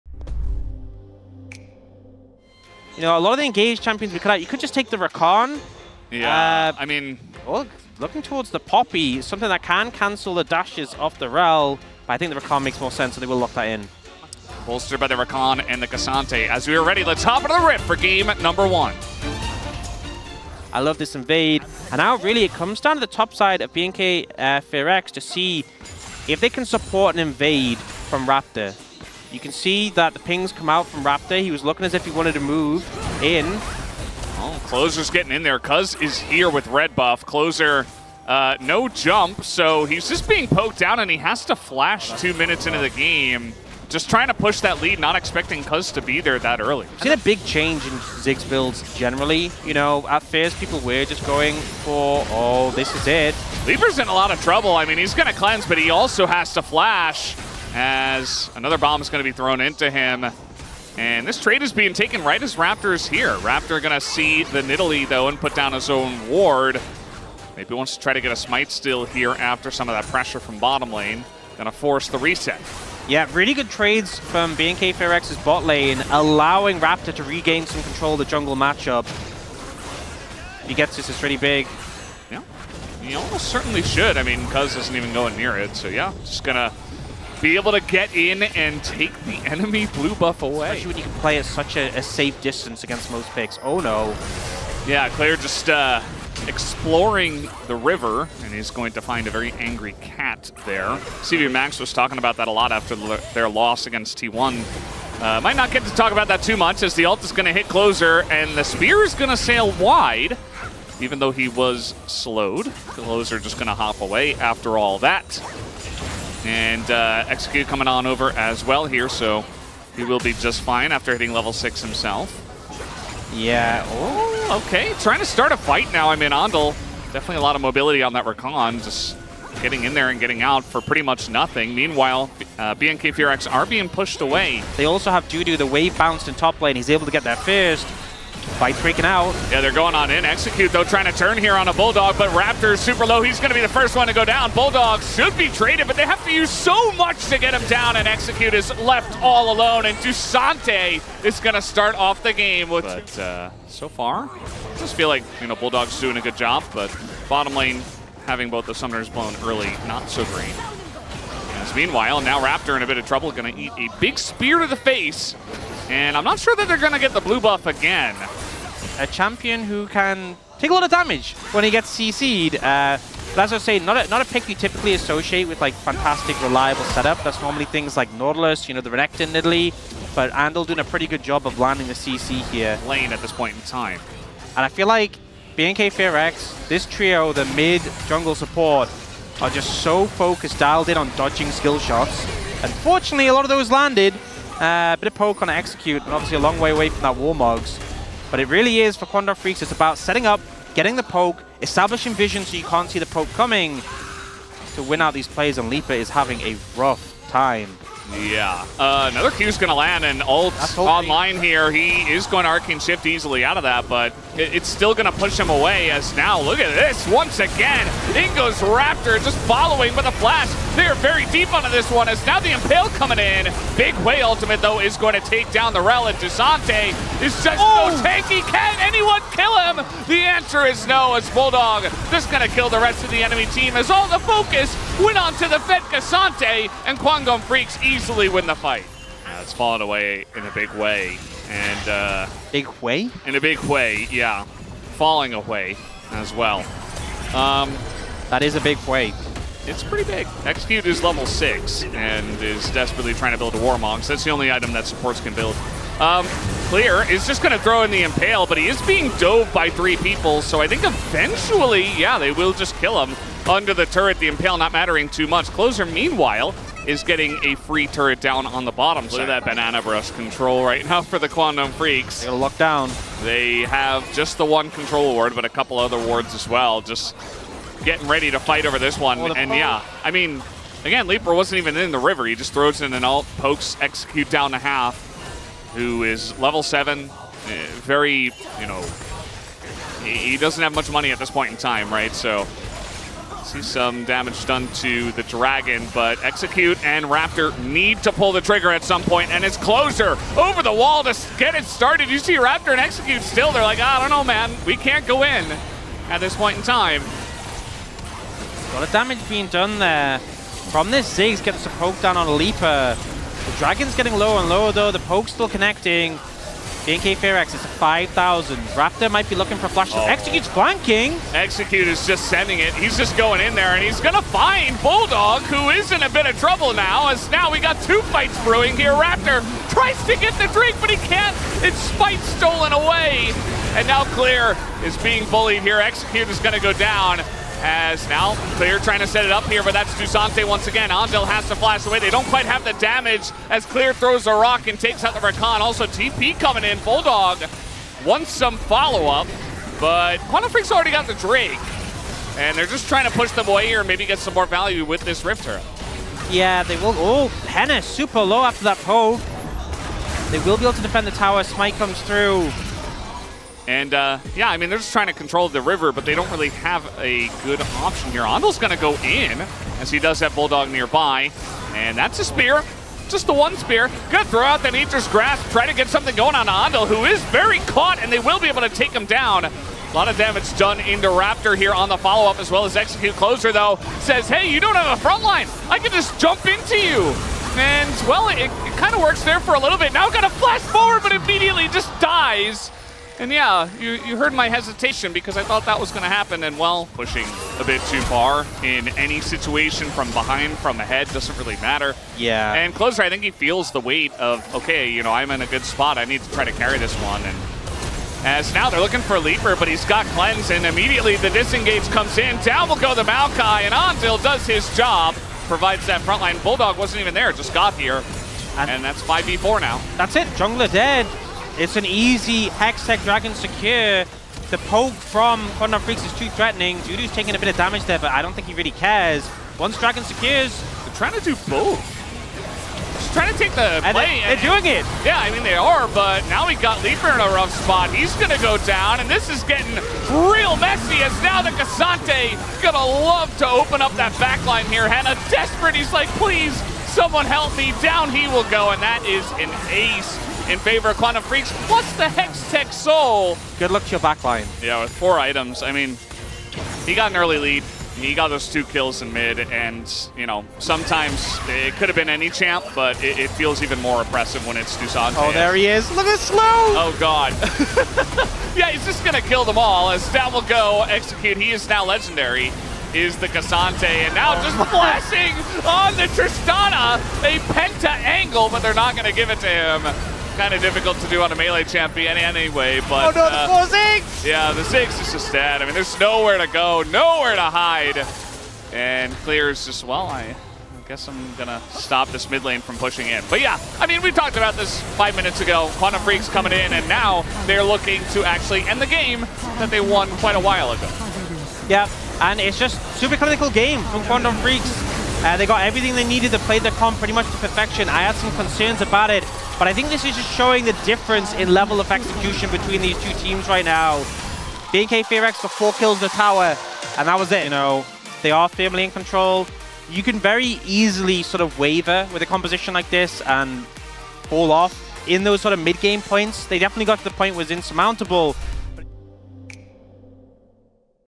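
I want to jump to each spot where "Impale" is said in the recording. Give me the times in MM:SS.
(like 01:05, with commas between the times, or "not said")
03:42, 04:18, 04:24.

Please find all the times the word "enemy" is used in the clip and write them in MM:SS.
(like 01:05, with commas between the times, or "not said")
01:29, 03:53.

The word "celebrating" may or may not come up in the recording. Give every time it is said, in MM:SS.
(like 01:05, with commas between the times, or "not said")
not said.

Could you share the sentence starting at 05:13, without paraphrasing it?
The Dragon's getting lower and lower, though.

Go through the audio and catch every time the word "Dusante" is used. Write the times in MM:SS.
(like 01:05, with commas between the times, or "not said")
02:29, 05:39, 07:44.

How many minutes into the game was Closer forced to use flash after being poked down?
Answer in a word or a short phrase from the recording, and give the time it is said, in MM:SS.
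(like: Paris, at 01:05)
2, at 00:42.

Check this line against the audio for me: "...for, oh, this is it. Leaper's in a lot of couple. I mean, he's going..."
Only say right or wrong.
wrong.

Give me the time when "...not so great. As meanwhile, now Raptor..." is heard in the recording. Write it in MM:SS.
02:39.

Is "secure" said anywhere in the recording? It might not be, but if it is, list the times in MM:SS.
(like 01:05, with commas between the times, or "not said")
07:03, 07:10.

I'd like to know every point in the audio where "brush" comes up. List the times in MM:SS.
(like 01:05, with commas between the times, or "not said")
04:29.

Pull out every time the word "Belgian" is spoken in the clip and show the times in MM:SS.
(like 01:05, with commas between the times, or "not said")
not said.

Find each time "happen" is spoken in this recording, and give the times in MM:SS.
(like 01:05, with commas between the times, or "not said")
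06:36.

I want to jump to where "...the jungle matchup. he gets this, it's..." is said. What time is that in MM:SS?
01:18.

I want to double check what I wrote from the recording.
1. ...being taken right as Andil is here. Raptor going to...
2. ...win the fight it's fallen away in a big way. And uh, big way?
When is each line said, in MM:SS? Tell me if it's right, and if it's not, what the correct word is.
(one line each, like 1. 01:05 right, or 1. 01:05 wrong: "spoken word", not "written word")
1. 01:01 wrong: "Raptor", not "Andil"
2. 03:58 right.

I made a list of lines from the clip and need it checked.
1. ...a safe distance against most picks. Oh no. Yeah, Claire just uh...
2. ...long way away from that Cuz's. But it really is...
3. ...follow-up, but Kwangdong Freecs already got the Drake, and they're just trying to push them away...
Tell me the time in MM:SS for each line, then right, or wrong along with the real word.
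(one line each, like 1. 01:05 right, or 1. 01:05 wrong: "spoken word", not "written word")
1. 01:31 right
2. 03:16 wrong: "Warmog", not "Cuz"
3. 05:48 right.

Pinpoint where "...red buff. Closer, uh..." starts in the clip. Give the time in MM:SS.
00:36.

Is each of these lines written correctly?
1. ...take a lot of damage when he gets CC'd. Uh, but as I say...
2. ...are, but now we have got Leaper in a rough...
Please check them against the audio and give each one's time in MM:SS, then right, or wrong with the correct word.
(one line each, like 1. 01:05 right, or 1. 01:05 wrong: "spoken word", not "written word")
1. 02:50 right
2. 07:15 right.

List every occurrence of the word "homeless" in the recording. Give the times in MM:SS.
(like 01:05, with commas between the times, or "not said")
not said.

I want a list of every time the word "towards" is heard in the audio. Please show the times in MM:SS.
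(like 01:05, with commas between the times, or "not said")
00:08.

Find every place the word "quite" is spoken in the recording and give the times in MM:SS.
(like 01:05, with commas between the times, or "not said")
05:42, 08:20.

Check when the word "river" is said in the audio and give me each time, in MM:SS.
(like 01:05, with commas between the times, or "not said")
01:37, 04:41, 06:05.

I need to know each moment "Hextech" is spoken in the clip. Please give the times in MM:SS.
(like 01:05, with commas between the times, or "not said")
07:02, 07:32.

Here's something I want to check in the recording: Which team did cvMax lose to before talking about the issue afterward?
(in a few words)
T1.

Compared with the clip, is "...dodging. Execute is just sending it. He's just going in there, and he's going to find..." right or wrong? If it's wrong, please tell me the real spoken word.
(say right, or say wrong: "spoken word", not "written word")
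wrong: "flanking", not "dodging".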